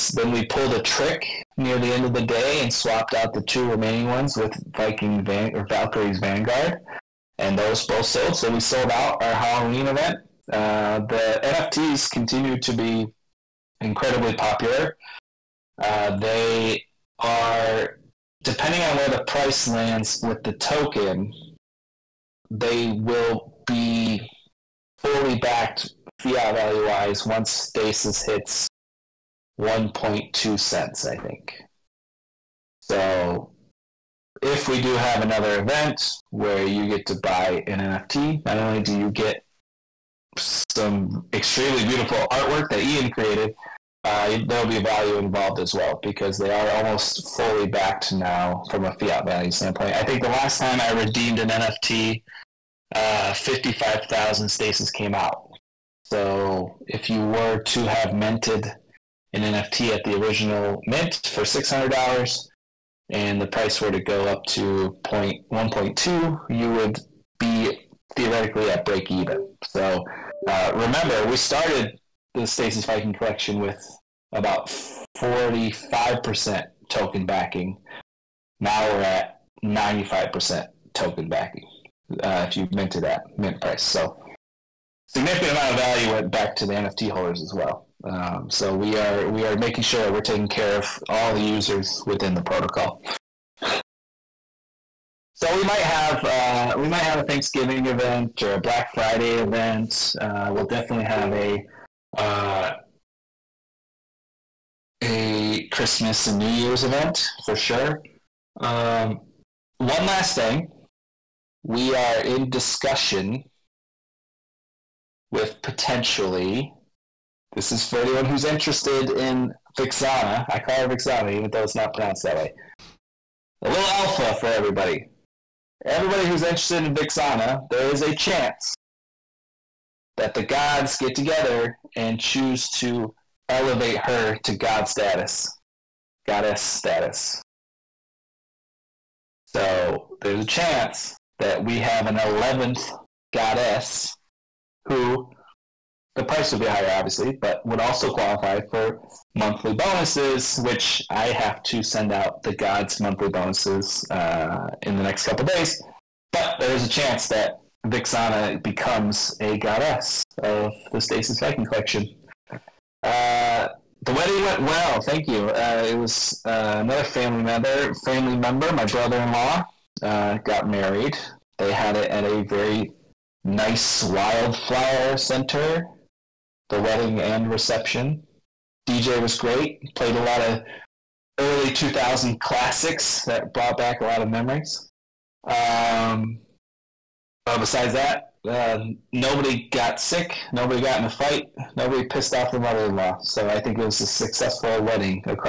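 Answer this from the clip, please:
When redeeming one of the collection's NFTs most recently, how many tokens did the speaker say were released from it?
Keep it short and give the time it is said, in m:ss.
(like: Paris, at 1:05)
55,000, at 0:53.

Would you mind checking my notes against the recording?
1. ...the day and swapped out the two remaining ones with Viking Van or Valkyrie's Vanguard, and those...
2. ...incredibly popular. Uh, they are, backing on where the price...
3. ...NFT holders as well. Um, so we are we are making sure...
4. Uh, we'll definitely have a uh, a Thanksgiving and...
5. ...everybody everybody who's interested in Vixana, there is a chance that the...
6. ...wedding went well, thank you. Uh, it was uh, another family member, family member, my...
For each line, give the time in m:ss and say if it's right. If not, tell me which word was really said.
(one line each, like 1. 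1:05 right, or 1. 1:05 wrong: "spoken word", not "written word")
1. 0:02 right
2. 0:13 wrong: "depending", not "backing"
3. 1:26 right
4. 1:40 wrong: "Christmas", not "Thanksgiving"
5. 2:04 right
6. 2:44 right.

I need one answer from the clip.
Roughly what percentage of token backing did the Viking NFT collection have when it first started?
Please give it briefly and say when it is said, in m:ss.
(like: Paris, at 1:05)
45%, at 1:15.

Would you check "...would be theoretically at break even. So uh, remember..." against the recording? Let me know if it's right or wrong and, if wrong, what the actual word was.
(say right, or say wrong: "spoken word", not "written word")
right.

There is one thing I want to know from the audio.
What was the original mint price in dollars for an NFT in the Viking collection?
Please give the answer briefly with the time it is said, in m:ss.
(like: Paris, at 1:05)
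$600, at 1:01.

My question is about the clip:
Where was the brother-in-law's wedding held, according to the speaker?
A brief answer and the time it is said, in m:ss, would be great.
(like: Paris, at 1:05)
wildflower center, at 2:54.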